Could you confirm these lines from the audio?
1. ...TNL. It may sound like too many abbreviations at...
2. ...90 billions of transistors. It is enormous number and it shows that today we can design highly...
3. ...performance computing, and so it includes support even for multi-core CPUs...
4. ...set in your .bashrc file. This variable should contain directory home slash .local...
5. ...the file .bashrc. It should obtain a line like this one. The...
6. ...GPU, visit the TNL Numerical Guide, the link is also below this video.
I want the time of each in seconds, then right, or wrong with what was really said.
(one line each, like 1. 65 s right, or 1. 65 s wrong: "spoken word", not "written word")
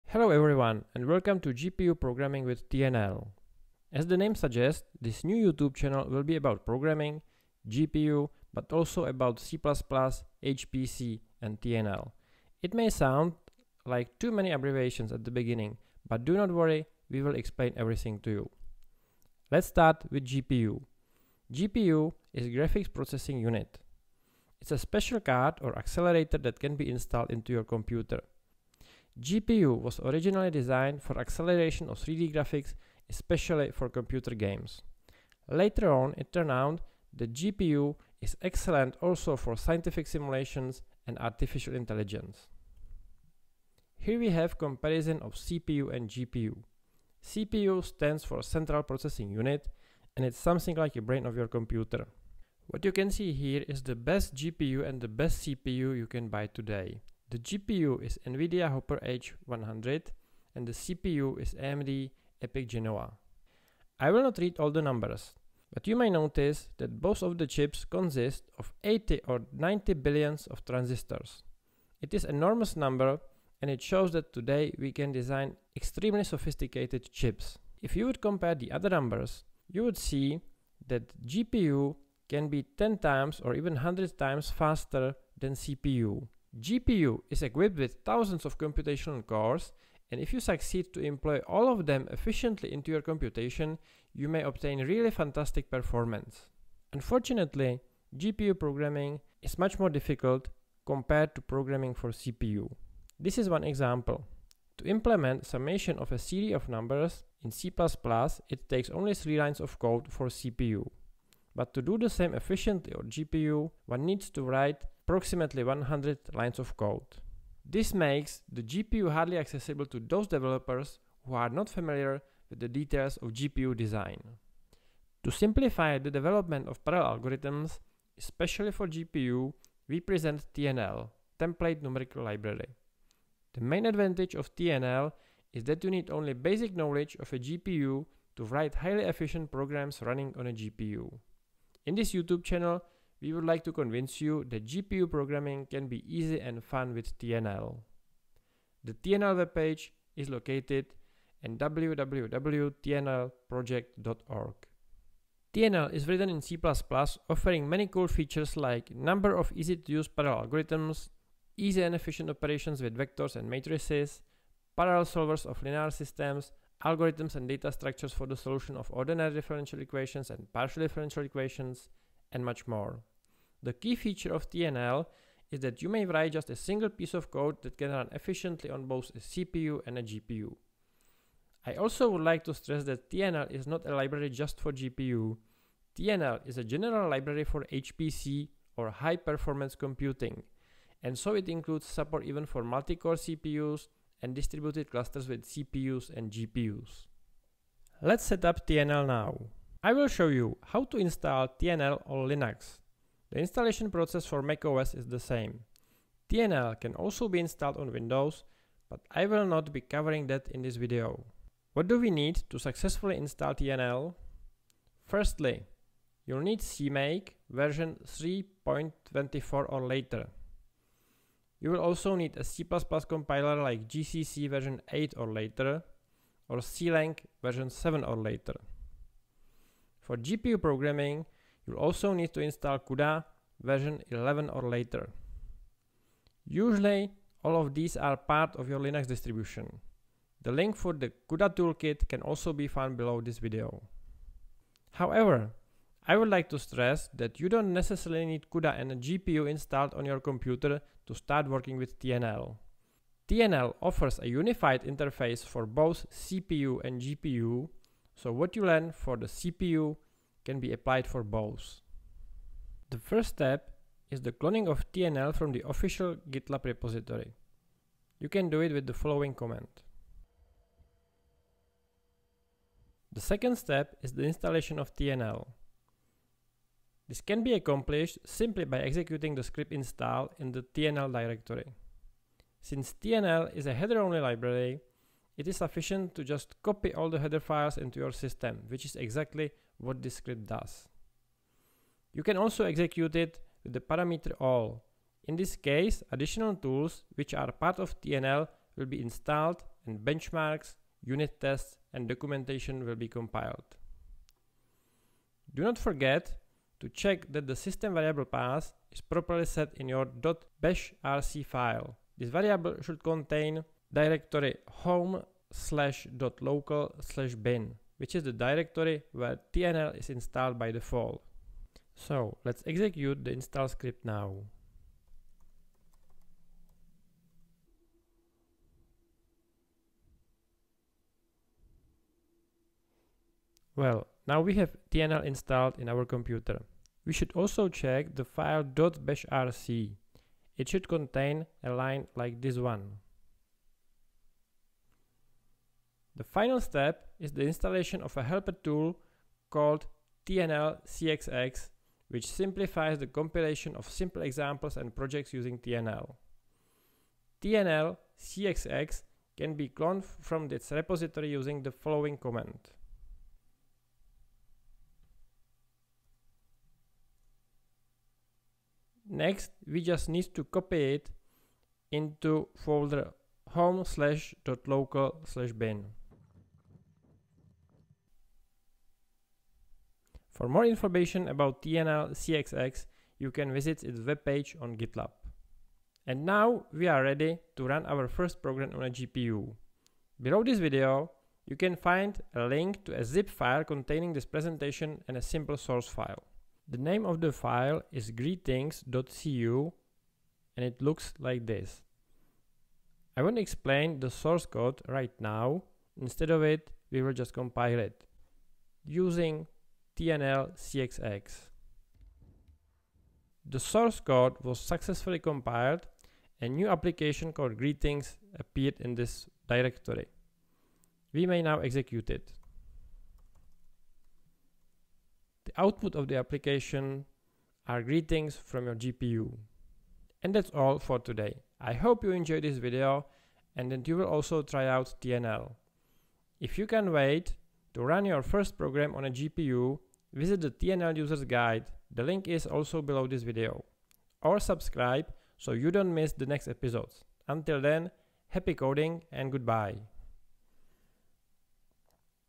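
1. 11 s right
2. 69 s wrong: "extremely", not "highly"
3. 189 s right
4. 309 s right
5. 338 s wrong: "contain", not "obtain"
6. 439 s wrong: "Users", not "Numerical".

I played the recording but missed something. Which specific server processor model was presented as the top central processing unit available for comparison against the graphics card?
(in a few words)
AMD EPYC Genoa.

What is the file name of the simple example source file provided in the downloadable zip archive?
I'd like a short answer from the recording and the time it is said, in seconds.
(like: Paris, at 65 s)
greetings.cu, at 398 s.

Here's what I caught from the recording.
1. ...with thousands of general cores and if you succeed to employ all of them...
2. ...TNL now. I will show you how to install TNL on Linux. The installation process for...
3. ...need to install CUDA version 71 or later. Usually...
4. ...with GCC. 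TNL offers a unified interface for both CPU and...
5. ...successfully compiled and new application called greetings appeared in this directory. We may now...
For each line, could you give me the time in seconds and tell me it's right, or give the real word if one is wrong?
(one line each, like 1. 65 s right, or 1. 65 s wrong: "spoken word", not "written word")
1. 87 s wrong: "computational", not "general"
2. 198 s right
3. 232 s wrong: "11", not "71"
4. 251 s wrong: "TNL", not "GCC"
5. 414 s right.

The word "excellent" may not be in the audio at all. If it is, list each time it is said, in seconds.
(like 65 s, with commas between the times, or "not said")
38 s.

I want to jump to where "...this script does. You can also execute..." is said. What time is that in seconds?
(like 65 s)
290 s.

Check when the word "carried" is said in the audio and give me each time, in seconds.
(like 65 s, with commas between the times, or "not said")
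not said.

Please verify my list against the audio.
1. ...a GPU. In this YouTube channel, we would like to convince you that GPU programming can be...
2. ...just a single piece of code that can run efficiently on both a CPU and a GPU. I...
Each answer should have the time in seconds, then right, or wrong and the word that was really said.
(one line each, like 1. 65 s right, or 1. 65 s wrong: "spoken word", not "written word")
1. 140 s right
2. 176 s right.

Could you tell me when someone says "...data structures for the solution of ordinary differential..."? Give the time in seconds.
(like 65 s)
167 s.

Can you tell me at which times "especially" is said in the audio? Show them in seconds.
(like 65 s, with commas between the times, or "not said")
33 s, 128 s.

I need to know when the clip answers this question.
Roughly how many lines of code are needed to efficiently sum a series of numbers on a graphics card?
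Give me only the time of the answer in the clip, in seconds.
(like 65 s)
115 s.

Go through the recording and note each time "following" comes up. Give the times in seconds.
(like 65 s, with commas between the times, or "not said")
268 s, 361 s.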